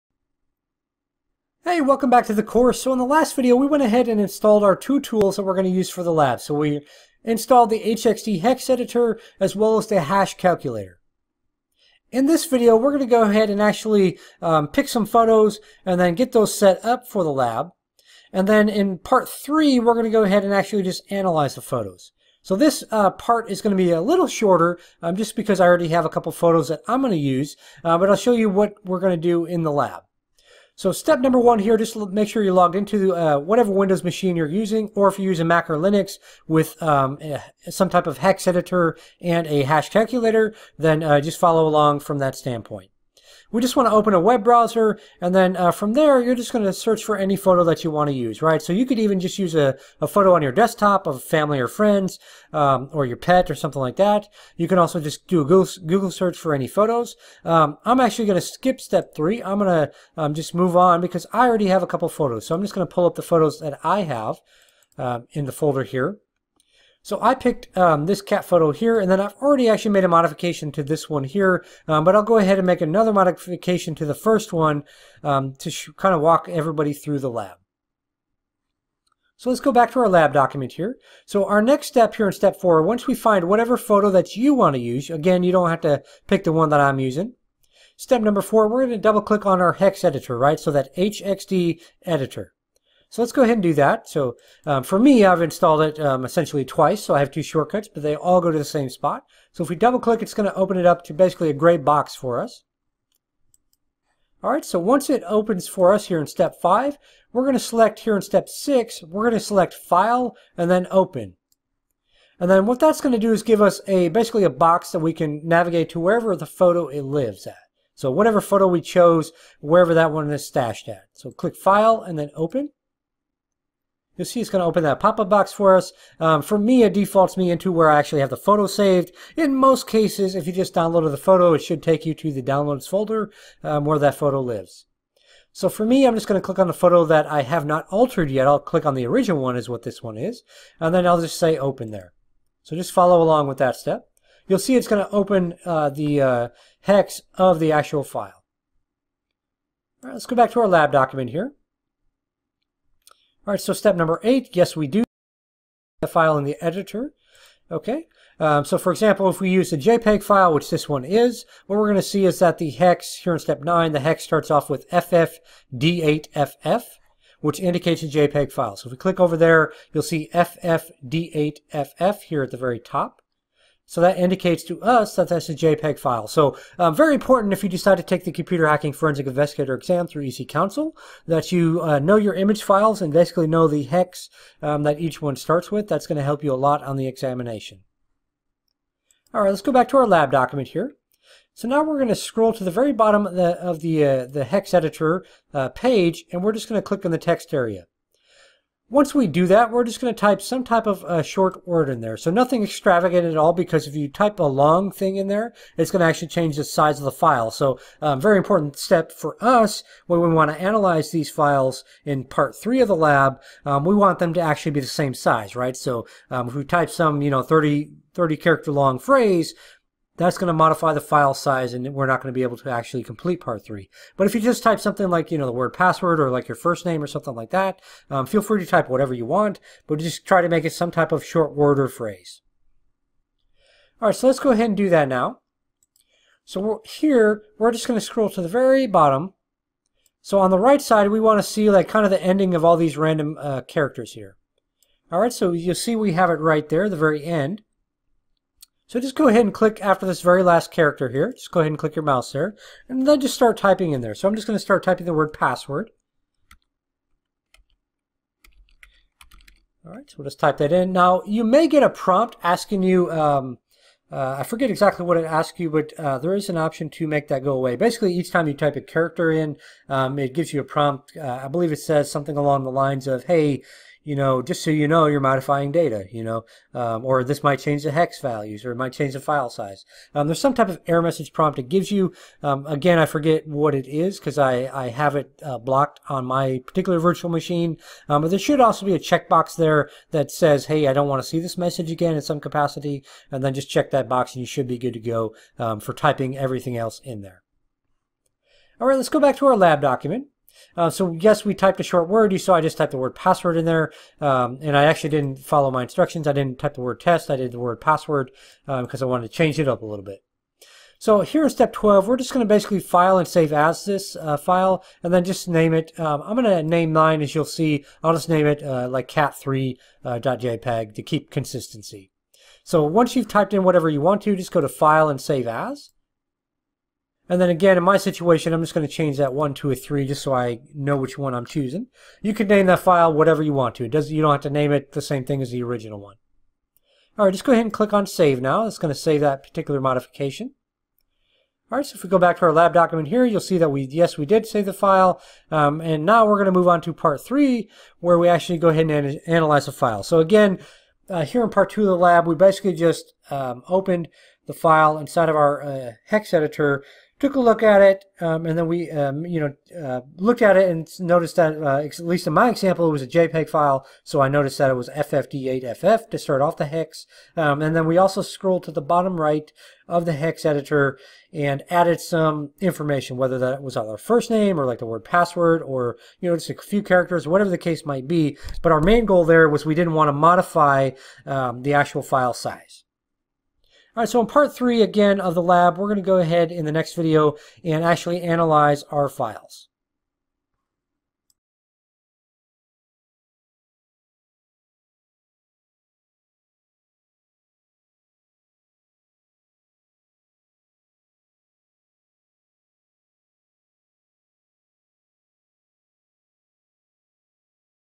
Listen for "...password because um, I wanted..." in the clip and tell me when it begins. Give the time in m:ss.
5:07.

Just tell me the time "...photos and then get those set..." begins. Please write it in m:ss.
0:15.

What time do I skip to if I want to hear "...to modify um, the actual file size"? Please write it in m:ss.
6:20.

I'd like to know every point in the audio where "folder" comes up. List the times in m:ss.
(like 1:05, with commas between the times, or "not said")
1:05, 2:12.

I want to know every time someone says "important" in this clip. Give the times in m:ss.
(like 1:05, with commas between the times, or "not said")
2:57, 3:28.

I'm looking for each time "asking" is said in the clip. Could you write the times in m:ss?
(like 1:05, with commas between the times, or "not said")
4:22.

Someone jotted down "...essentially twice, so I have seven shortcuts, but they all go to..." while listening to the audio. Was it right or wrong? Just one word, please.
wrong.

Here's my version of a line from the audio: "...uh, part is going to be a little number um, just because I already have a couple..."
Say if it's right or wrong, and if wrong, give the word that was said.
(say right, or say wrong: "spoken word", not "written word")
wrong: "shorter", not "number".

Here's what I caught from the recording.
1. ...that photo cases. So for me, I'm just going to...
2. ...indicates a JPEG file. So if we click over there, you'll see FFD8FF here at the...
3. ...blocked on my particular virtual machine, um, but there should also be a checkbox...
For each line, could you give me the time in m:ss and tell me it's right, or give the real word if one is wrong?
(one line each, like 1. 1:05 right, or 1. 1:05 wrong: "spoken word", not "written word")
1. 2:13 wrong: "lives", not "cases"
2. 2:47 right
3. 4:45 right.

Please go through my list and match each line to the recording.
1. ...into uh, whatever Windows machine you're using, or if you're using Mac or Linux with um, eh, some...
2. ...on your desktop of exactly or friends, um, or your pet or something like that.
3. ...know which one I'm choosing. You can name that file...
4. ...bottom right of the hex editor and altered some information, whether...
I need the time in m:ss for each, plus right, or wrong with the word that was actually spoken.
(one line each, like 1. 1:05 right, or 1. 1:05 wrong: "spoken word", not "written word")
1. 0:32 right
2. 0:50 wrong: "family", not "exactly"
3. 5:30 right
4. 6:08 wrong: "added", not "altered".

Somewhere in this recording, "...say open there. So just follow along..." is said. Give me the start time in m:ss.
2:21.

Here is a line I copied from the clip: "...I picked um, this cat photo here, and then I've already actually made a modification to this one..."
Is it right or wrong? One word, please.
right.